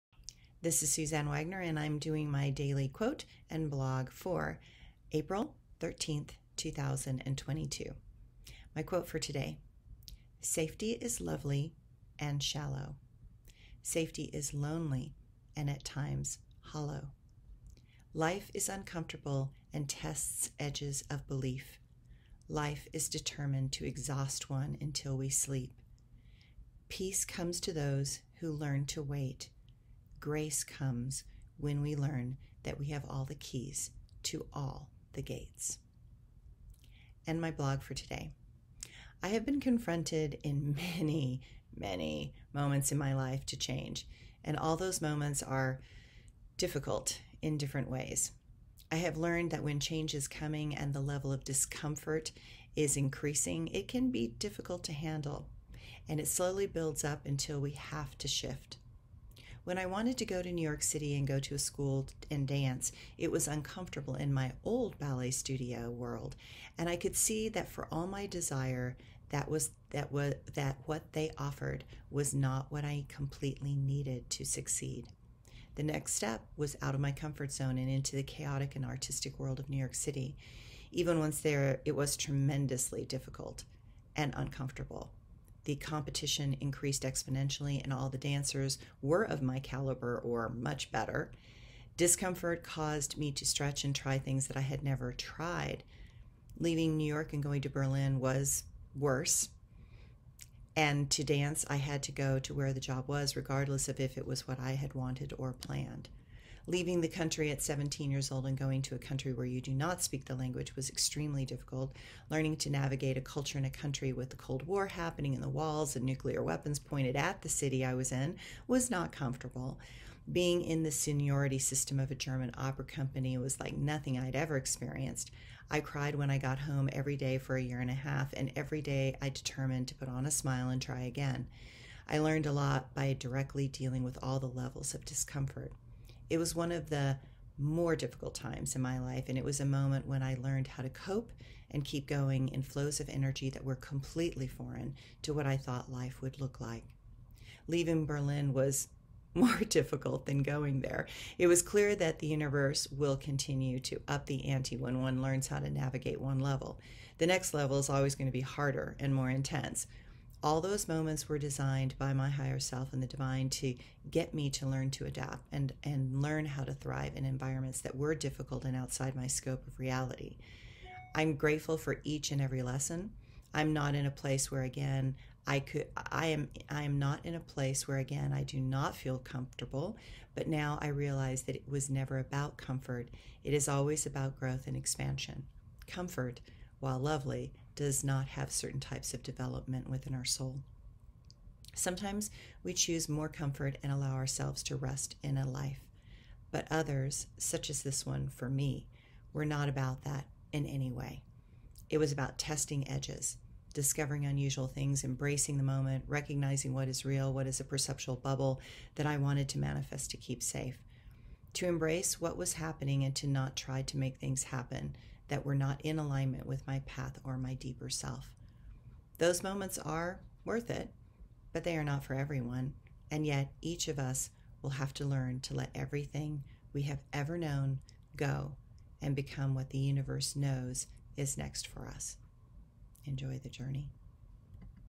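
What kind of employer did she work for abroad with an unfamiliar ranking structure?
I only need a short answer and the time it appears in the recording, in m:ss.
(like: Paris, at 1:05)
German opera company, at 2:02.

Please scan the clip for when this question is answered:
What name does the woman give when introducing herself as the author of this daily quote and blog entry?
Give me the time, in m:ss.
0:00.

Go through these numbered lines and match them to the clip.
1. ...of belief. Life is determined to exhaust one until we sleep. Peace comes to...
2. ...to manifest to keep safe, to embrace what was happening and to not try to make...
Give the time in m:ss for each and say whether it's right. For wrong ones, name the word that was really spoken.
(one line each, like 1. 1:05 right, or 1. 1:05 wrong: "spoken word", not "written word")
1. 0:21 right
2. 3:29 right.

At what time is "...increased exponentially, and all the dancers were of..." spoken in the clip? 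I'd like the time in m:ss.
1:26.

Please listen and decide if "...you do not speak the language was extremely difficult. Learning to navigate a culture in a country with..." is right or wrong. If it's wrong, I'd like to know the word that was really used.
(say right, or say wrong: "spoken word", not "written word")
right.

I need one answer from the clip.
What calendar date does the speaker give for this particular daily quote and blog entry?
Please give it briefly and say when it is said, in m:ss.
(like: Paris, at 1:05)
April 13th, 2022, at 0:05.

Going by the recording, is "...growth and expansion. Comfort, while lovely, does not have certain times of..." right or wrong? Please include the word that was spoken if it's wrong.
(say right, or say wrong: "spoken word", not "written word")
wrong: "types", not "times".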